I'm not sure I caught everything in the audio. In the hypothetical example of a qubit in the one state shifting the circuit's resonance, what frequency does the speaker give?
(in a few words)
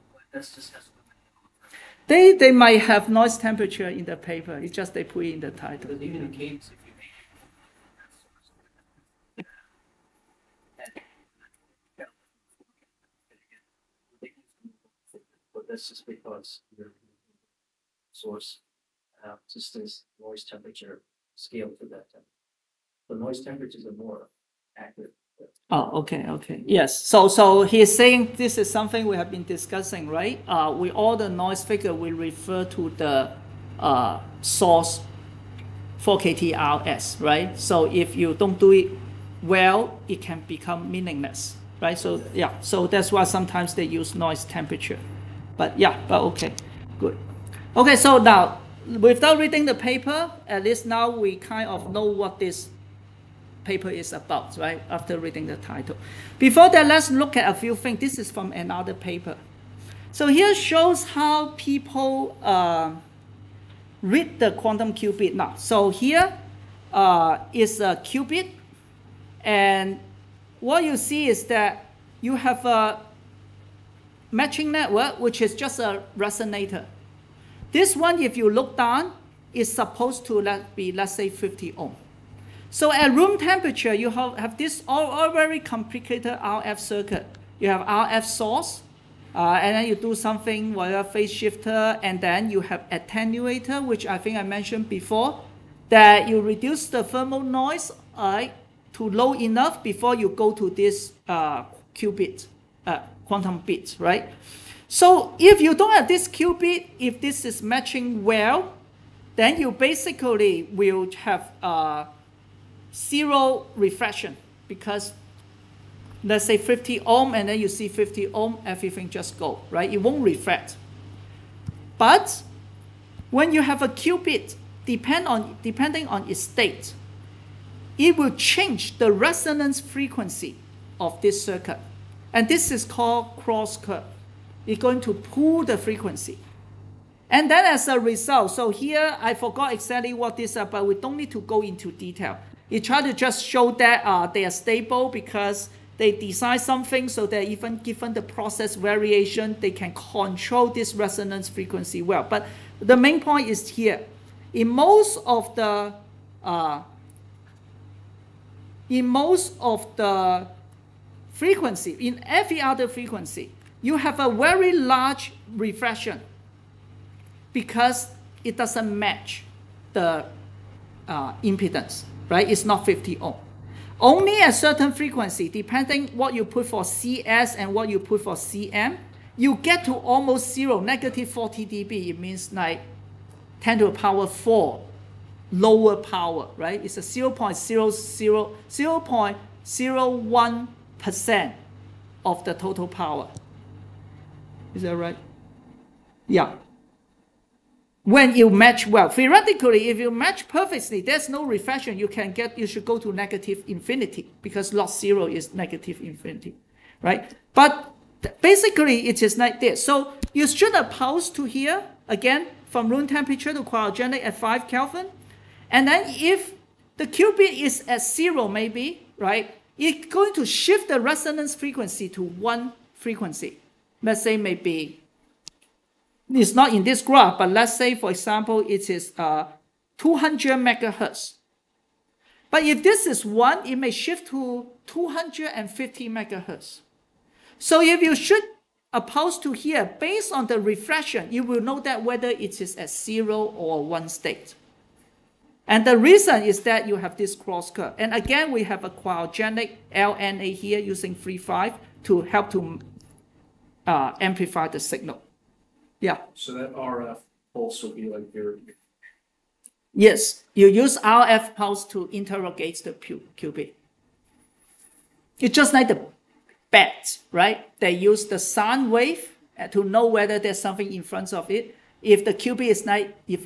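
250 megahertz.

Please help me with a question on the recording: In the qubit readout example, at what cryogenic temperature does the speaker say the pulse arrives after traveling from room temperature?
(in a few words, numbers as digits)
5 Kelvin.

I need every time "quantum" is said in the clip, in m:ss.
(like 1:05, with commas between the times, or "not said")
1:04, 1:43.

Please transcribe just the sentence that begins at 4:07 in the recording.
And again, we have a cryogenic LNA here using 3-5 to help to uh, amplify the signal.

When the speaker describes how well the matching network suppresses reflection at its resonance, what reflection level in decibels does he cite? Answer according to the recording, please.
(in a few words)
-40 dB.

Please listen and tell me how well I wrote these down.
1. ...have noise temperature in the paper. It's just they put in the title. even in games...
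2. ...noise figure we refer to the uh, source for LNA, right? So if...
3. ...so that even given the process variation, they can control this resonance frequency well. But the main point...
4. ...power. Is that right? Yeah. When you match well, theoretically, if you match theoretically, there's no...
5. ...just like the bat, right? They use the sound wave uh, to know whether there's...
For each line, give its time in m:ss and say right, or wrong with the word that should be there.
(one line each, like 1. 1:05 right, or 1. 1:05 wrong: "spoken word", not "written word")
1. 0:02 right
2. 0:31 wrong: "KTRS", not "LNA"
3. 2:27 right
4. 3:12 wrong: "perfectly", not "theoretically"
5. 4:25 right.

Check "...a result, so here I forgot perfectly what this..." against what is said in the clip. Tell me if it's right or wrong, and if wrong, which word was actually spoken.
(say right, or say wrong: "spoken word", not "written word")
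wrong: "exactly", not "perfectly".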